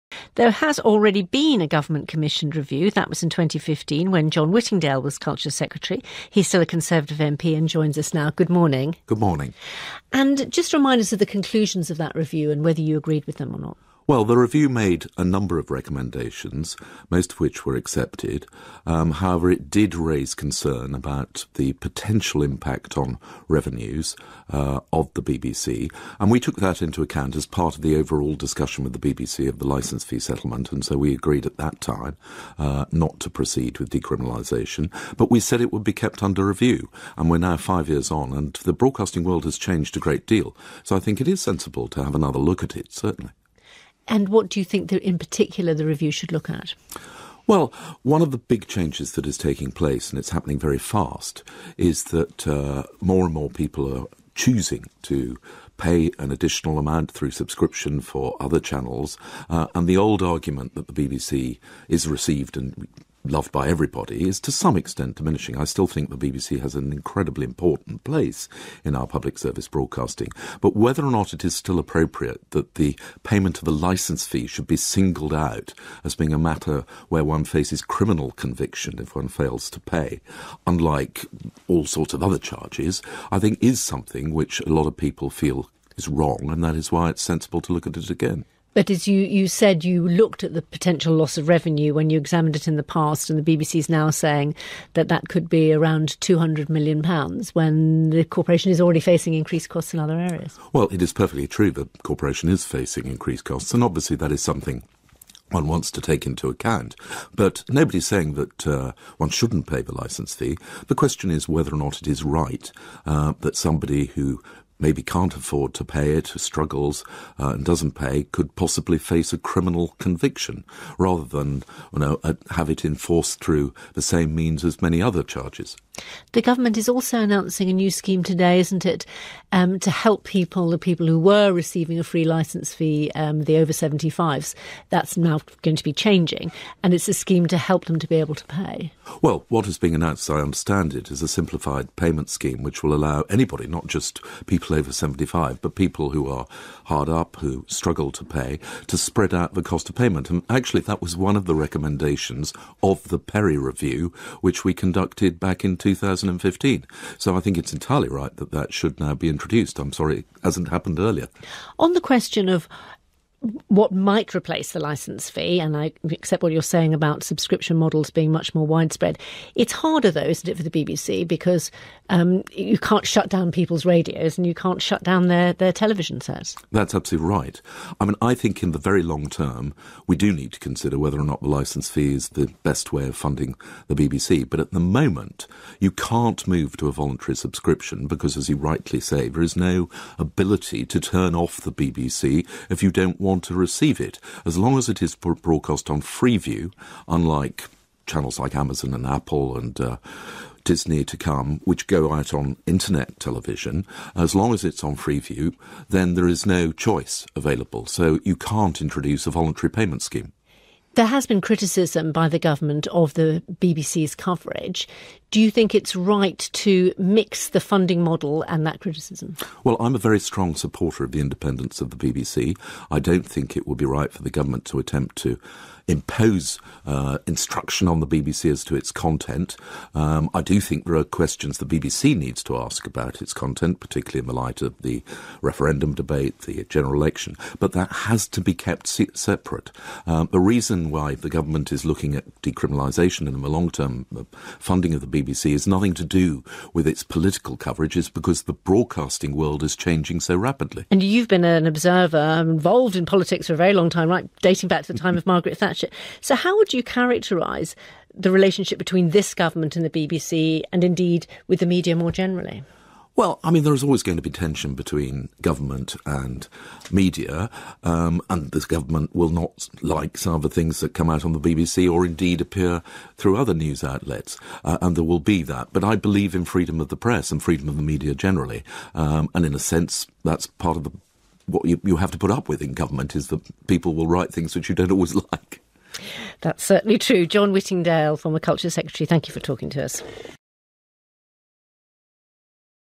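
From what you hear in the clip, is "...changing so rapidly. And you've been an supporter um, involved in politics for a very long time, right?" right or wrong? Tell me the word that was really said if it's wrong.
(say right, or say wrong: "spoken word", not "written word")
wrong: "observer", not "supporter".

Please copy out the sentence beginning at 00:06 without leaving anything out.
He's still a Conservative MP and joins us now.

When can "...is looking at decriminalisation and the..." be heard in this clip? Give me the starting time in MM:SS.
04:01.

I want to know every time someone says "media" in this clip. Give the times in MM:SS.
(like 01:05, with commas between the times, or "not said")
04:21, 04:26, 04:37.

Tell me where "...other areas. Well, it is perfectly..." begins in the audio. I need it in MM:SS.
01:39.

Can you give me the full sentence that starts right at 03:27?
So you can't introduce a voluntary payment scheme.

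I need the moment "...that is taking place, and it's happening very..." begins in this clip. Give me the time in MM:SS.
00:49.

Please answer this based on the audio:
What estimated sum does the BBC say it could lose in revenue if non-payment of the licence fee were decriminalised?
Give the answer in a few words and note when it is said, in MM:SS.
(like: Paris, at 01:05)
£200 million, at 01:36.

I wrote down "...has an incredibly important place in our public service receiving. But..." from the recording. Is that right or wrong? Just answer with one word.
wrong.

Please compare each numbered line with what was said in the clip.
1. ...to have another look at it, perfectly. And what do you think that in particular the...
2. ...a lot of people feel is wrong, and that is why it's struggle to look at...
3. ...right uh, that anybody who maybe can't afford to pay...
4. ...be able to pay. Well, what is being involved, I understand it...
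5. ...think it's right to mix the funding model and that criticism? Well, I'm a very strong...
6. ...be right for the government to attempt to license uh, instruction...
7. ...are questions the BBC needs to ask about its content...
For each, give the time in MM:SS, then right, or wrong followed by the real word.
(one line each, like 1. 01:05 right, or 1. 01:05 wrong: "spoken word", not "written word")
1. 00:41 wrong: "certainly", not "perfectly"
2. 01:24 wrong: "sensible", not "struggle"
3. 01:52 wrong: "somebody", not "anybody"
4. 02:18 wrong: "announced", not "involved"
5. 03:35 right
6. 03:43 wrong: "impose", not "license"
7. 03:50 right.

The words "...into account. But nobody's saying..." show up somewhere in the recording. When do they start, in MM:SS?
01:46.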